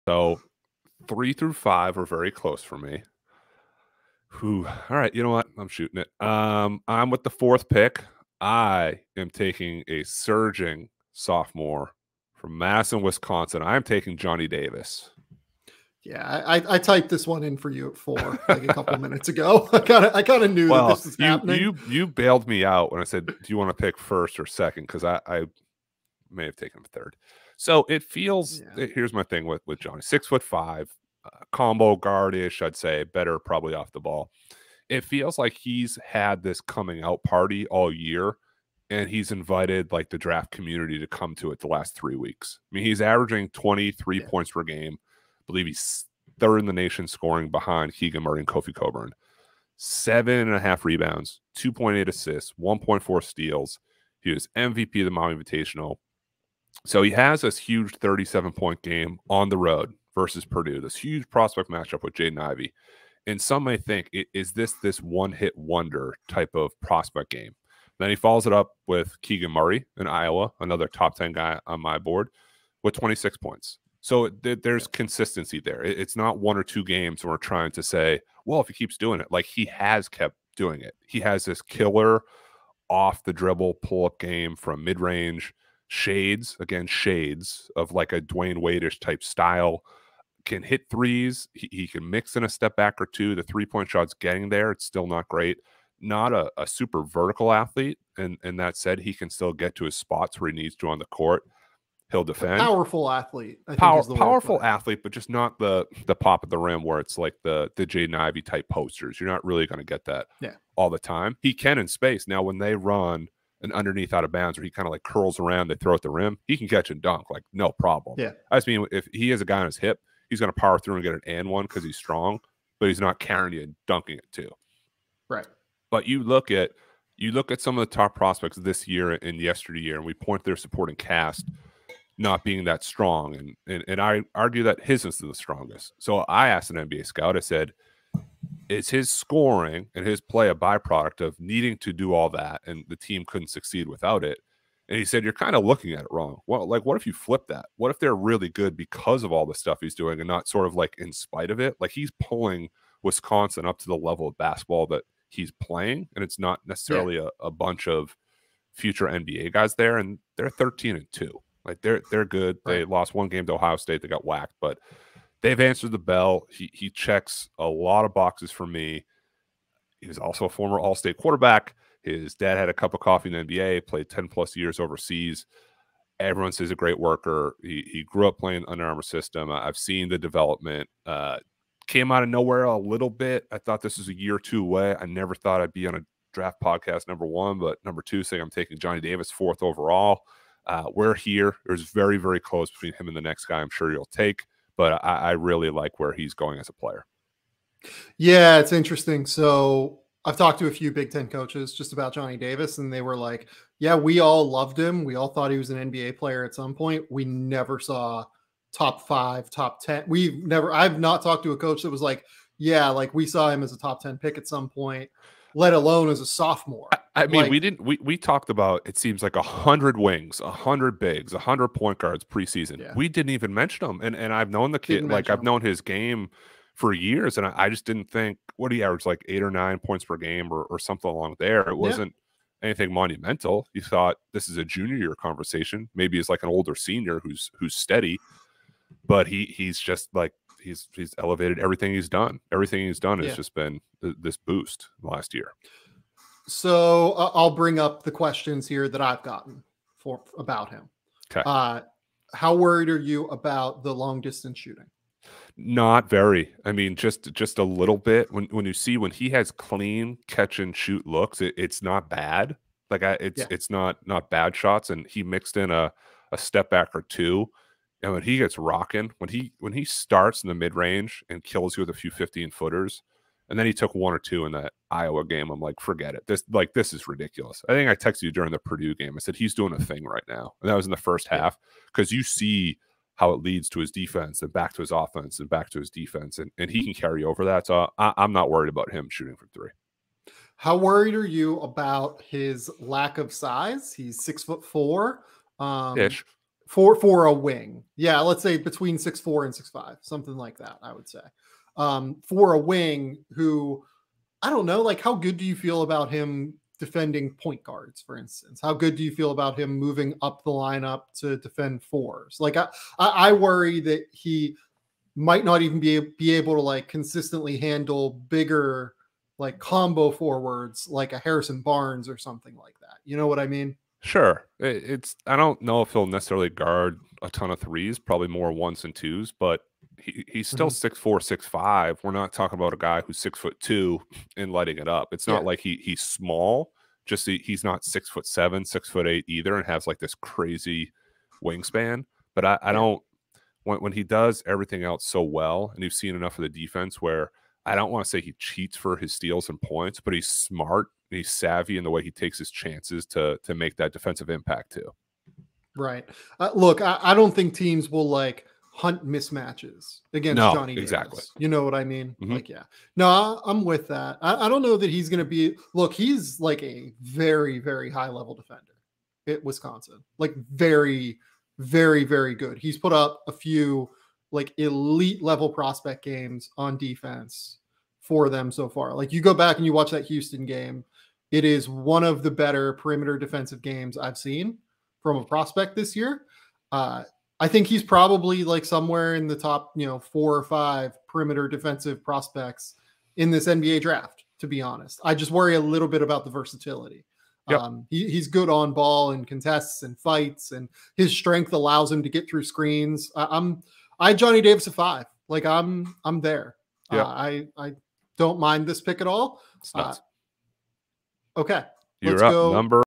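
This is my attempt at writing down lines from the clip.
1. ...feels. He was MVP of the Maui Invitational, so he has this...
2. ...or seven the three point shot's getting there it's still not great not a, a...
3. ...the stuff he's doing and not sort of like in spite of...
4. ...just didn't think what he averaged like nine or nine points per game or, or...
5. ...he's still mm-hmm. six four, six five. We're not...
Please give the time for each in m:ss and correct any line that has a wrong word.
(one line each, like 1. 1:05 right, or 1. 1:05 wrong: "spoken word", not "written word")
1. 0:53 wrong: "steals", not "feels"
2. 1:33 wrong: "two", not "seven"
3. 2:29 right
4. 3:47 wrong: "eight", not "nine"
5. 5:30 right.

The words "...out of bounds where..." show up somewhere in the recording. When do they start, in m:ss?
1:54.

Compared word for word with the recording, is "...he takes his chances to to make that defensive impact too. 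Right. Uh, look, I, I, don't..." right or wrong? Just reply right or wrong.
right.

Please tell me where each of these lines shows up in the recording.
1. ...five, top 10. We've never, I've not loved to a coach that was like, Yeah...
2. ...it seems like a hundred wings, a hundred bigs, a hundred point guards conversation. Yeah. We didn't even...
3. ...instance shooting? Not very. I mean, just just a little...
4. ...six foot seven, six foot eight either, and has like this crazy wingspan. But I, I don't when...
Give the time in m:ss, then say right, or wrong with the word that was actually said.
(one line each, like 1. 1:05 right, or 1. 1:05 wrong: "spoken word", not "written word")
1. 3:29 wrong: "talked", not "loved"
2. 3:38 wrong: "preseason", not "conversation"
3. 4:14 wrong: "distance", not "instance"
4. 5:37 right.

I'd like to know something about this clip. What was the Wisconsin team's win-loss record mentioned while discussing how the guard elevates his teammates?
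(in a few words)
13-2.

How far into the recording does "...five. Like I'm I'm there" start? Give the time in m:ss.
6:44.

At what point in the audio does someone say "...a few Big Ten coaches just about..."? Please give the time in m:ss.
3:20.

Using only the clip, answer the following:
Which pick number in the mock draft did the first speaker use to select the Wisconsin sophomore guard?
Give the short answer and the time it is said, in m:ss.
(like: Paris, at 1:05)
4th, at 0:07.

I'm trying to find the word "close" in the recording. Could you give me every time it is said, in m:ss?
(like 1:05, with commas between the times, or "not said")
0:02, 3:12.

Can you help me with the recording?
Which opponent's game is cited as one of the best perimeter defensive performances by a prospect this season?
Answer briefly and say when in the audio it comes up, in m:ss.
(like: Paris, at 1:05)
Houston, at 6:20.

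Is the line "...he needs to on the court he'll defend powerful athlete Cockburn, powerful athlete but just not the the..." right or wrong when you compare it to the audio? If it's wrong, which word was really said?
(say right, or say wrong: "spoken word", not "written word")
wrong: "Power", not "Cockburn".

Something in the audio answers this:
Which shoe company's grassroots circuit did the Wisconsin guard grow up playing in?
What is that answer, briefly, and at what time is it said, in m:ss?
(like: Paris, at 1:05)
Under Armour, at 2:58.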